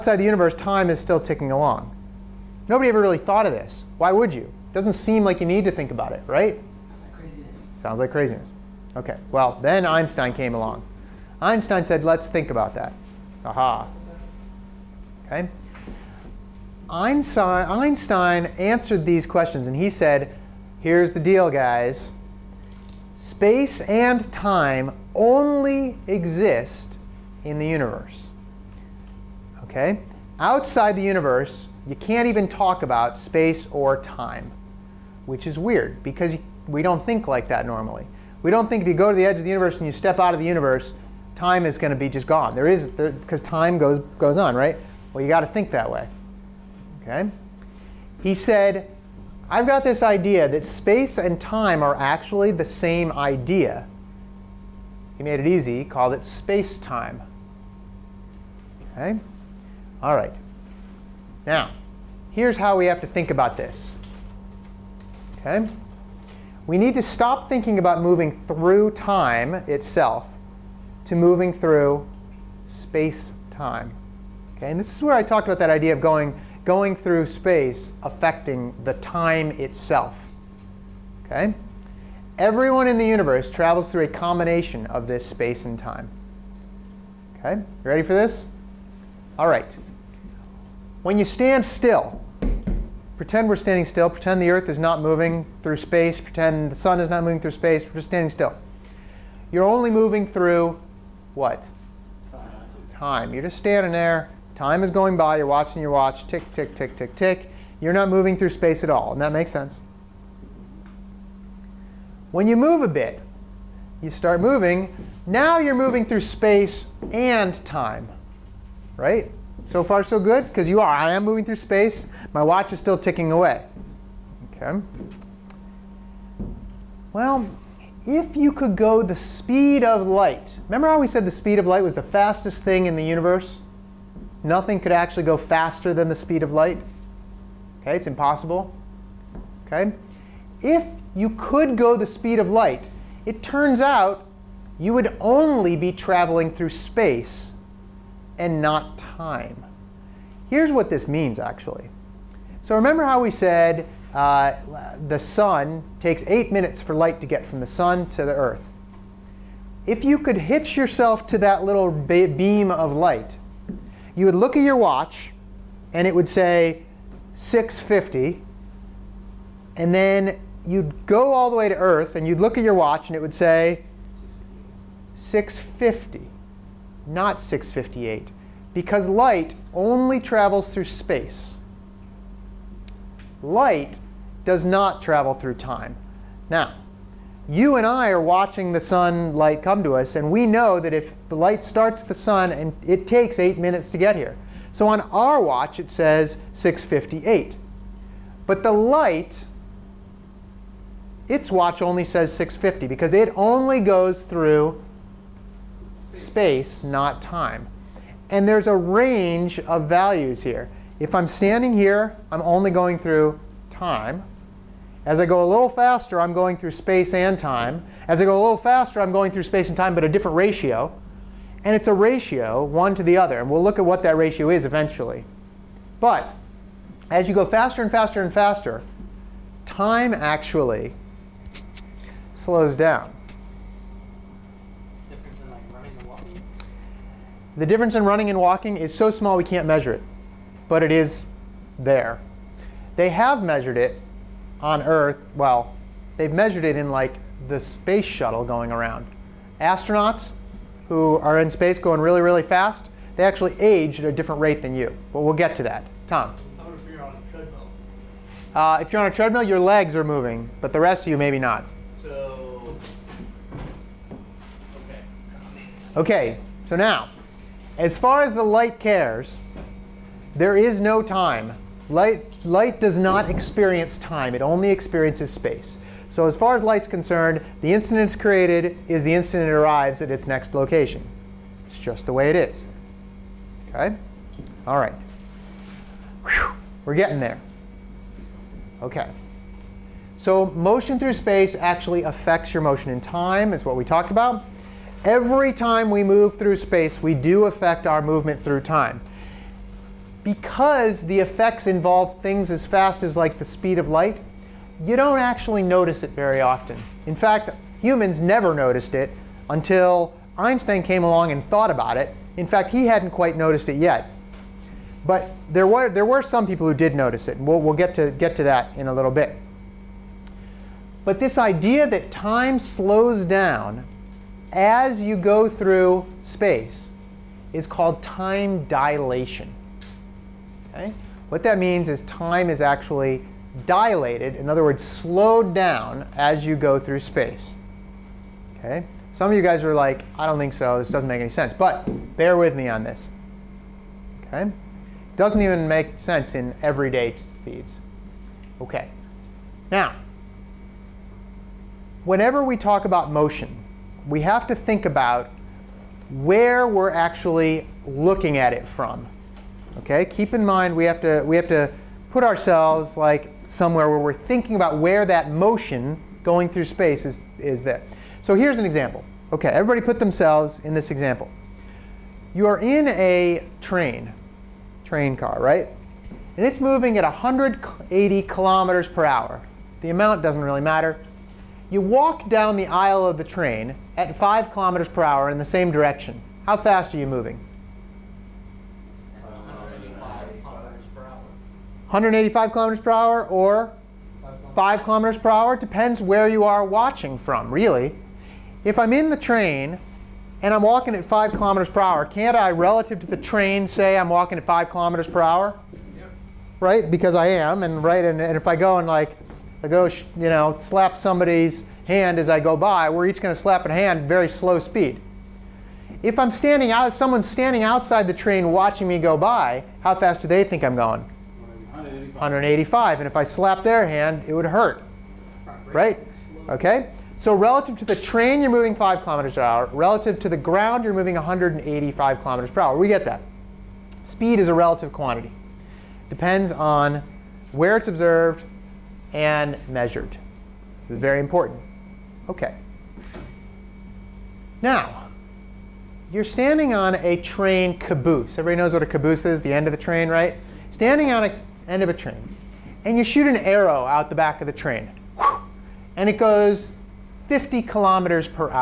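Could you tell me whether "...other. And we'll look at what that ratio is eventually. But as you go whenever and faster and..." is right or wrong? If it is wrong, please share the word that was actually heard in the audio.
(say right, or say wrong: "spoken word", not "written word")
wrong: "faster", not "whenever".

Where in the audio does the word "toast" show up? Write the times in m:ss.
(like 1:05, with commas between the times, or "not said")
not said.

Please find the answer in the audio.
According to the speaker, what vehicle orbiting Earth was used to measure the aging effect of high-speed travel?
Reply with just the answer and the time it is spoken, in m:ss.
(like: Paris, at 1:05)
space shuttle, at 4:07.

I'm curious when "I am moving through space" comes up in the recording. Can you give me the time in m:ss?
2:00.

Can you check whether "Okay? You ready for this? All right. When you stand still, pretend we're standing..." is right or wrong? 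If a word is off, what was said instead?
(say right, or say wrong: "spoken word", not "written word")
right.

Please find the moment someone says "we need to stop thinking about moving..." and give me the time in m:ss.
1:06.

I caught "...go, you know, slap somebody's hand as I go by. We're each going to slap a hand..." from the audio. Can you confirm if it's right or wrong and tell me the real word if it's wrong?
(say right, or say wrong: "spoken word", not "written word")
right.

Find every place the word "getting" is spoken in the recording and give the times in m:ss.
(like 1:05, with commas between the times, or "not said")
4:46.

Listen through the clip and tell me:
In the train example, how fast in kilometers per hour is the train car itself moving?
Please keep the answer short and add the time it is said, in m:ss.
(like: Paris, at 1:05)
180, at 6:17.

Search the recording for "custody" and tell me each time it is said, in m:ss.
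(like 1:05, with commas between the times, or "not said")
not said.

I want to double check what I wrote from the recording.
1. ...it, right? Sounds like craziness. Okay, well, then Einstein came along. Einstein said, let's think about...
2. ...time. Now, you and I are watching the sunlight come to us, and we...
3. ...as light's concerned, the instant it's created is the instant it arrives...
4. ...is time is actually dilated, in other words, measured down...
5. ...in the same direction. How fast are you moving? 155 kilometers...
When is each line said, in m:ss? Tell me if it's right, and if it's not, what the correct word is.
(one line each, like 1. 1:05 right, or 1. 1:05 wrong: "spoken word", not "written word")
1. 0:06 right
2. 3:05 right
3. 4:36 right
4. 5:31 wrong: "slowed", not "measured"
5. 6:25 wrong: "185", not "155".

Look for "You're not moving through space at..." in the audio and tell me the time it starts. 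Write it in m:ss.
1:47.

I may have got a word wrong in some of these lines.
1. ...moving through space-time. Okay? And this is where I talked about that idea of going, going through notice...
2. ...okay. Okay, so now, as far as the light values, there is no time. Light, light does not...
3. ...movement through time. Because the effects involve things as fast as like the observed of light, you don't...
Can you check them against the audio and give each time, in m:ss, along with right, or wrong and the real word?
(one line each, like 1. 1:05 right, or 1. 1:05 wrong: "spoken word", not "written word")
1. 1:11 wrong: "space", not "notice"
2. 4:24 wrong: "cares", not "values"
3. 4:58 wrong: "speed", not "observed".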